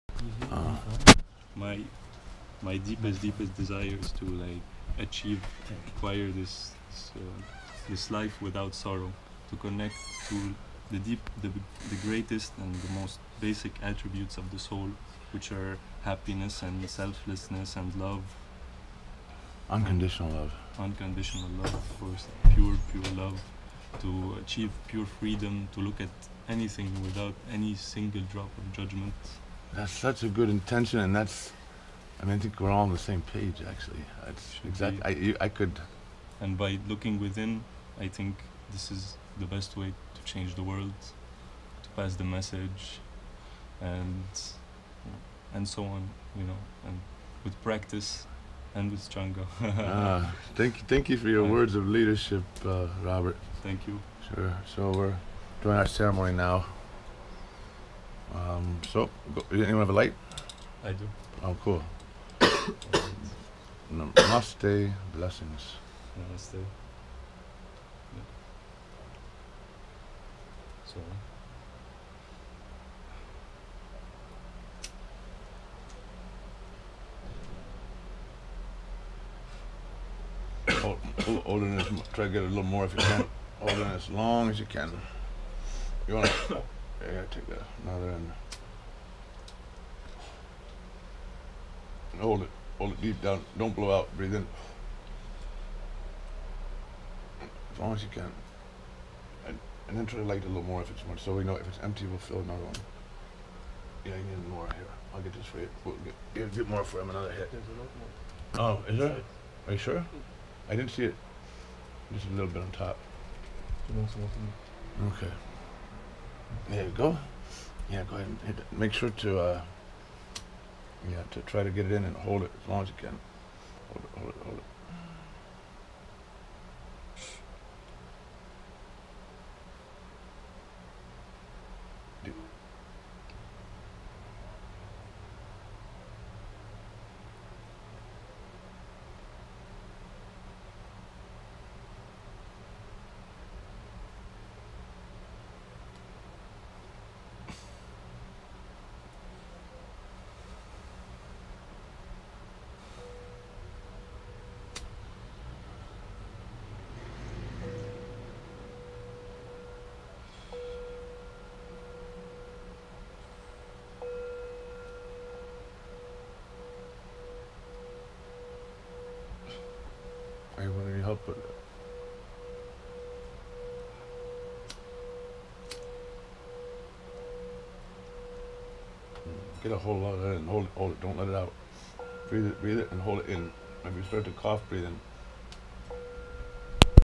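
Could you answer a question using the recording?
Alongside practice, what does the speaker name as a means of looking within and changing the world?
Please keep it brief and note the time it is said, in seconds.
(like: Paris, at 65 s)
changa, at 49 s.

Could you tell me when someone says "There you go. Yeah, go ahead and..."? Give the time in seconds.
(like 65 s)
116 s.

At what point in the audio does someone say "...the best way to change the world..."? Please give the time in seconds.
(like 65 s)
39 s.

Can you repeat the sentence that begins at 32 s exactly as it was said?
I mean, I think we're all on the same page.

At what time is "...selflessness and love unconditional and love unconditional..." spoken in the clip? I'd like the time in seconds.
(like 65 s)
16 s.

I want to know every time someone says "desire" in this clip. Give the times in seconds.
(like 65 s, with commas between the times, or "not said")
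3 s.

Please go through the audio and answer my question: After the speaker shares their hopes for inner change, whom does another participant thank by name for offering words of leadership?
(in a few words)
Robert.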